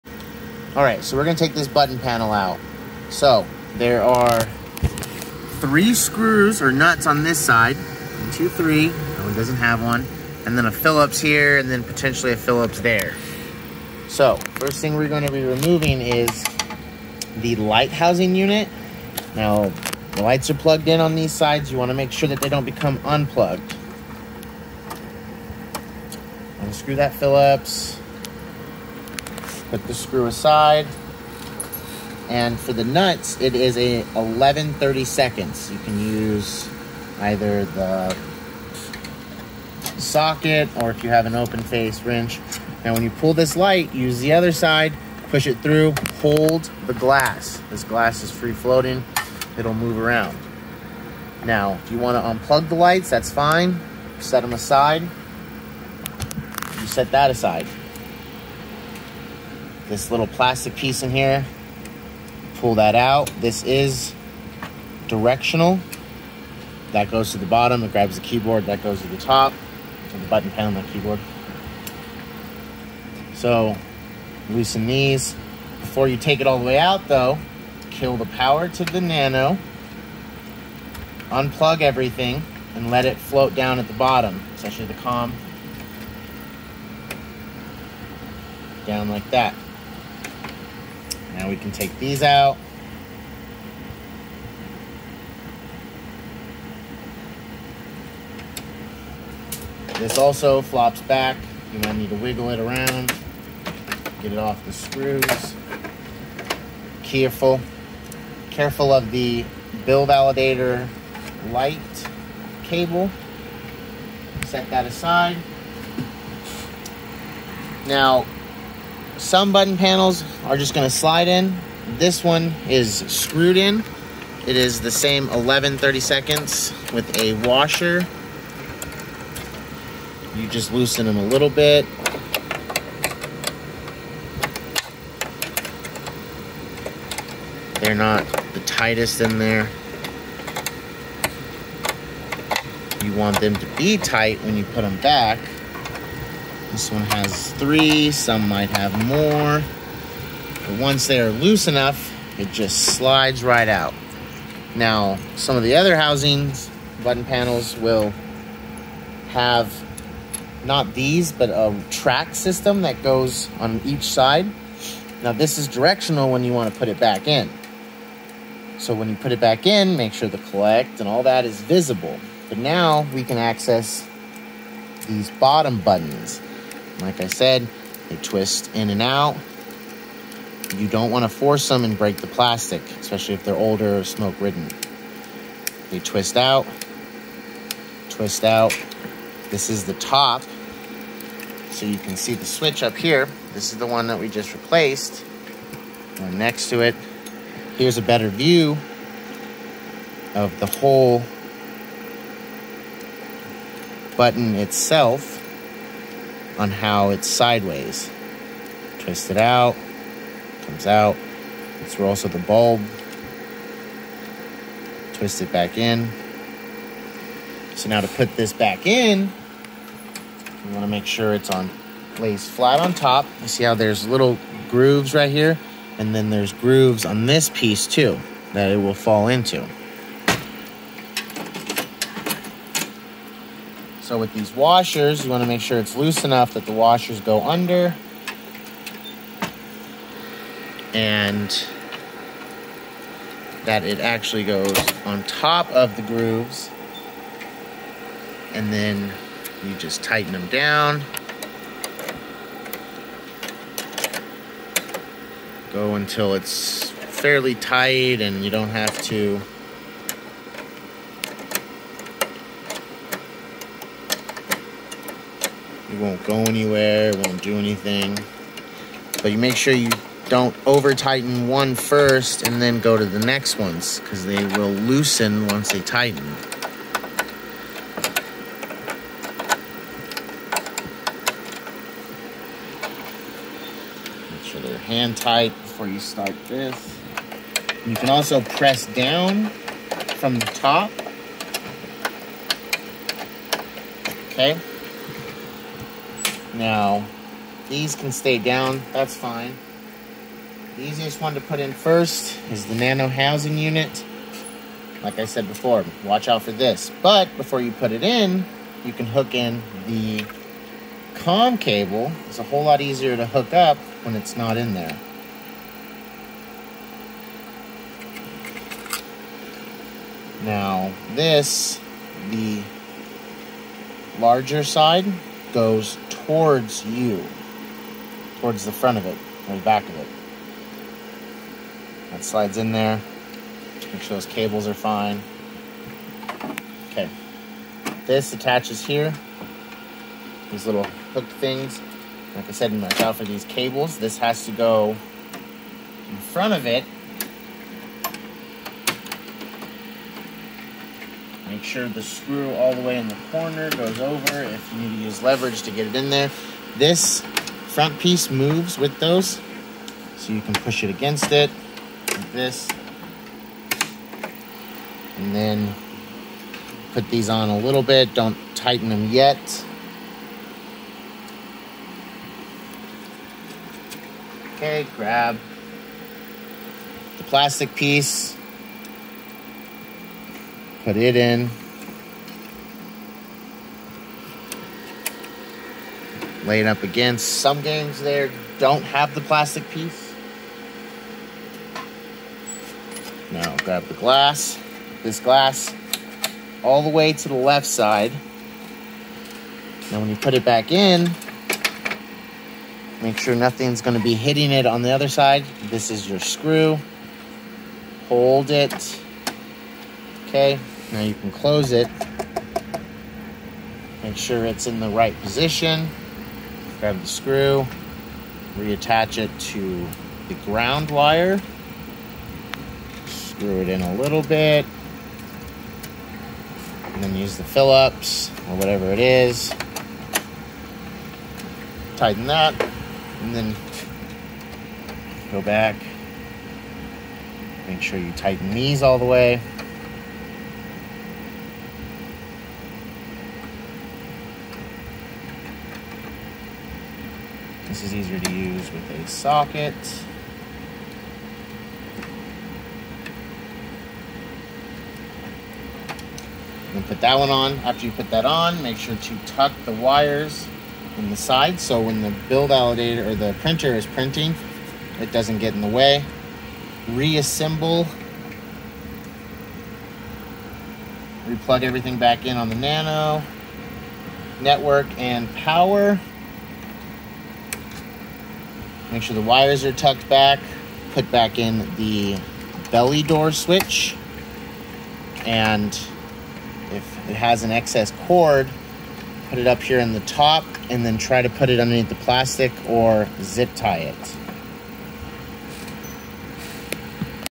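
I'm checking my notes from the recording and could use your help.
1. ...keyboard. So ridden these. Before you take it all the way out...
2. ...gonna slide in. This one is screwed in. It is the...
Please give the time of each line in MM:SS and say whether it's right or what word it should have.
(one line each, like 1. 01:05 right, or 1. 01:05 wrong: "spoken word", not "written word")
1. 01:10 wrong: "loosen", not "ridden"
2. 02:00 right.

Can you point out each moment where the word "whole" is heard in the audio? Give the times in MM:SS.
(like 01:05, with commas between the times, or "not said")
03:20, 05:12.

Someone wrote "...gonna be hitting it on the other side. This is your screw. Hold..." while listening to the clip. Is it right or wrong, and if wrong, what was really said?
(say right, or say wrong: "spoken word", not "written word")
right.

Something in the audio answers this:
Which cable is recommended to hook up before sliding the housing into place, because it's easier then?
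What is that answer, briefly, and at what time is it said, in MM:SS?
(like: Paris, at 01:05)
The com cable, at 05:11.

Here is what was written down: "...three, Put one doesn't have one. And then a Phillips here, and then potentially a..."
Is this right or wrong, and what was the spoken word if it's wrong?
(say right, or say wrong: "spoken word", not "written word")
wrong: "That", not "Put".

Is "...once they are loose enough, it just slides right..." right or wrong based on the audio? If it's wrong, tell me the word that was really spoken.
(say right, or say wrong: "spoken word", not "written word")
right.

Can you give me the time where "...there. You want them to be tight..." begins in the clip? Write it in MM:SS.
02:19.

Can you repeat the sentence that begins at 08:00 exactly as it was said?
Put back in the belly door switch.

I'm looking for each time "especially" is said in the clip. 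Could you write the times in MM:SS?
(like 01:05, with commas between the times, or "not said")
01:24, 03:02.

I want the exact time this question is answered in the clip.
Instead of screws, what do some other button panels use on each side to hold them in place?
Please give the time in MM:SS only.
02:41.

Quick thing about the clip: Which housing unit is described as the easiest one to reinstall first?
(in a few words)
Nano housing unit.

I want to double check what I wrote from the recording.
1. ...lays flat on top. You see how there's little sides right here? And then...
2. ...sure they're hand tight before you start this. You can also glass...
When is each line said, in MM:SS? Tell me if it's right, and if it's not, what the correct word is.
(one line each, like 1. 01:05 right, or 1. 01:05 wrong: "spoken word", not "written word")
1. 03:42 wrong: "grooves", not "sides"
2. 04:44 wrong: "press", not "glass".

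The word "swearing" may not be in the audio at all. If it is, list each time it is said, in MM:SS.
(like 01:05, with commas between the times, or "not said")
not said.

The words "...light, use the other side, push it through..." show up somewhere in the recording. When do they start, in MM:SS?
00:43.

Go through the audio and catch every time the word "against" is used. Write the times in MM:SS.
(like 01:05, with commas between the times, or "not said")
06:00, 06:26.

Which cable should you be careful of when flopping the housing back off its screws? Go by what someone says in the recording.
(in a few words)
Bill validator light cable.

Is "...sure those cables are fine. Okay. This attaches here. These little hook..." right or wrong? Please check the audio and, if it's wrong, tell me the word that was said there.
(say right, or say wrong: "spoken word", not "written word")
right.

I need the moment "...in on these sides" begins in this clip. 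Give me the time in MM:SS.
00:20.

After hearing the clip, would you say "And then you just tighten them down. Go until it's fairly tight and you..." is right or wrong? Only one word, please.
right.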